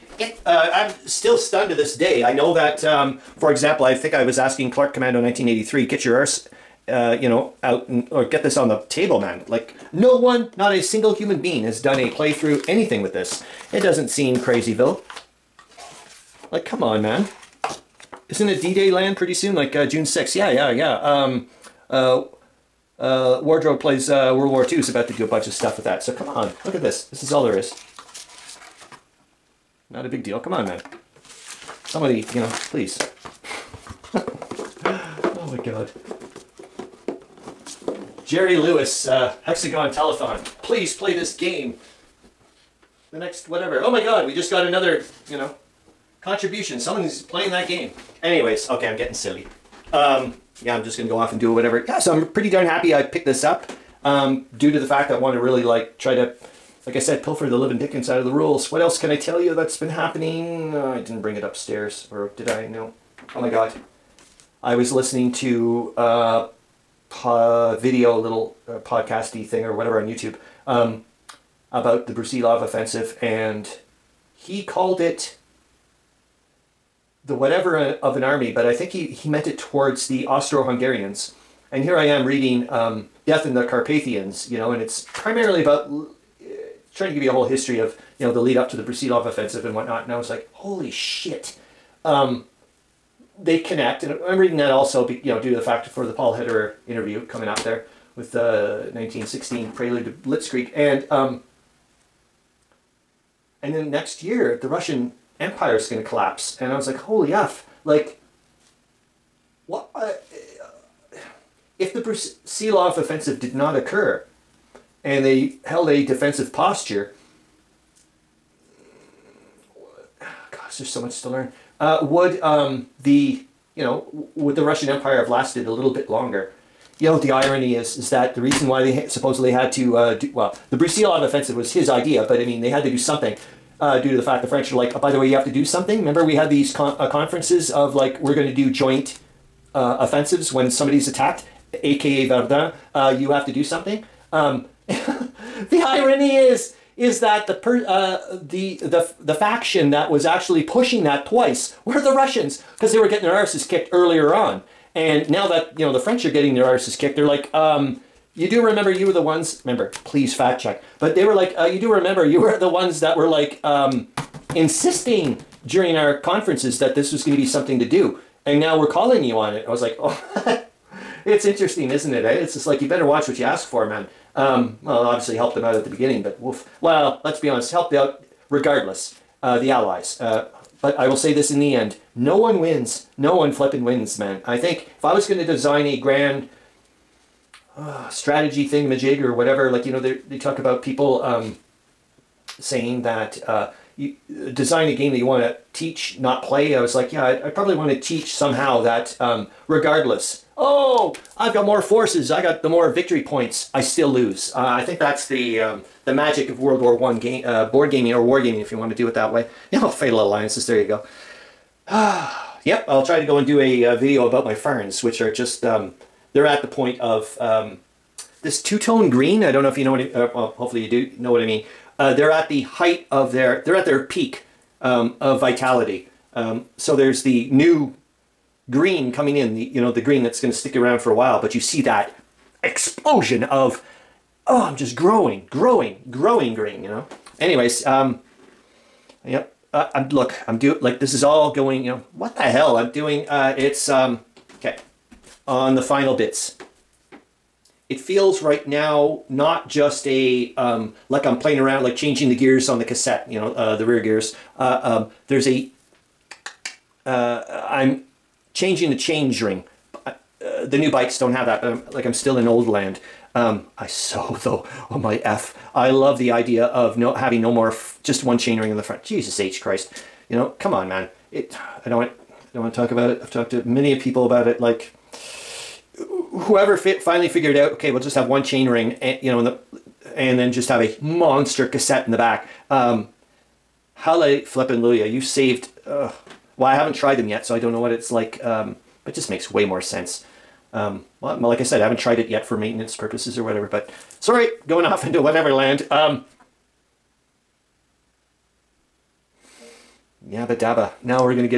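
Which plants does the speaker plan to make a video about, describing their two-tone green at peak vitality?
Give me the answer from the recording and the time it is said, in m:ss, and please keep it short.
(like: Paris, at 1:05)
ferns, at 3:34.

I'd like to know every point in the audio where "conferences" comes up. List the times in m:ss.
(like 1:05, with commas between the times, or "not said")
2:17, 2:46.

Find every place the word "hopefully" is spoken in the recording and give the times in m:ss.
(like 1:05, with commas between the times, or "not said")
3:40.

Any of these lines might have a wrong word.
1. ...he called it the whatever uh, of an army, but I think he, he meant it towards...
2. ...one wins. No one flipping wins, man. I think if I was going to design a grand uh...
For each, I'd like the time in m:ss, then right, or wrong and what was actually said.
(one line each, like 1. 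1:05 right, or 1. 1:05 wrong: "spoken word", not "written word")
1. 1:14 right
2. 3:02 right.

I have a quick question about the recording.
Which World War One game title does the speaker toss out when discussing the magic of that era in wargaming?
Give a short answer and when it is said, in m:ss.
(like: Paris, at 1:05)
Fatal Alliances, at 3:29.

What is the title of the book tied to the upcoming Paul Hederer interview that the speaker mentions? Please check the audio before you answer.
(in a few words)
1916 Prelude to Blitzkrieg.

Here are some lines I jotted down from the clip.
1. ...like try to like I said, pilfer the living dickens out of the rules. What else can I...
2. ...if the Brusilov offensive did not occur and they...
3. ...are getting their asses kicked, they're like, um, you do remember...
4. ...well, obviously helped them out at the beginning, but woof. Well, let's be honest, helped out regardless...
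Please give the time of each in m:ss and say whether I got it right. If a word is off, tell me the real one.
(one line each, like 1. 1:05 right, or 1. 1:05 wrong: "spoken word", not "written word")
1. 0:55 right
2. 1:51 right
3. 2:36 right
4. 2:54 right.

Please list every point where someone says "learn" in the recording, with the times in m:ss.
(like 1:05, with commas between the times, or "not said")
2:01.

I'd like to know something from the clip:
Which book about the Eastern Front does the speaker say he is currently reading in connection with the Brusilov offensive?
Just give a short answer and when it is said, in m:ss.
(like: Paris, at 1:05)
Death in the Carpathians, at 1:23.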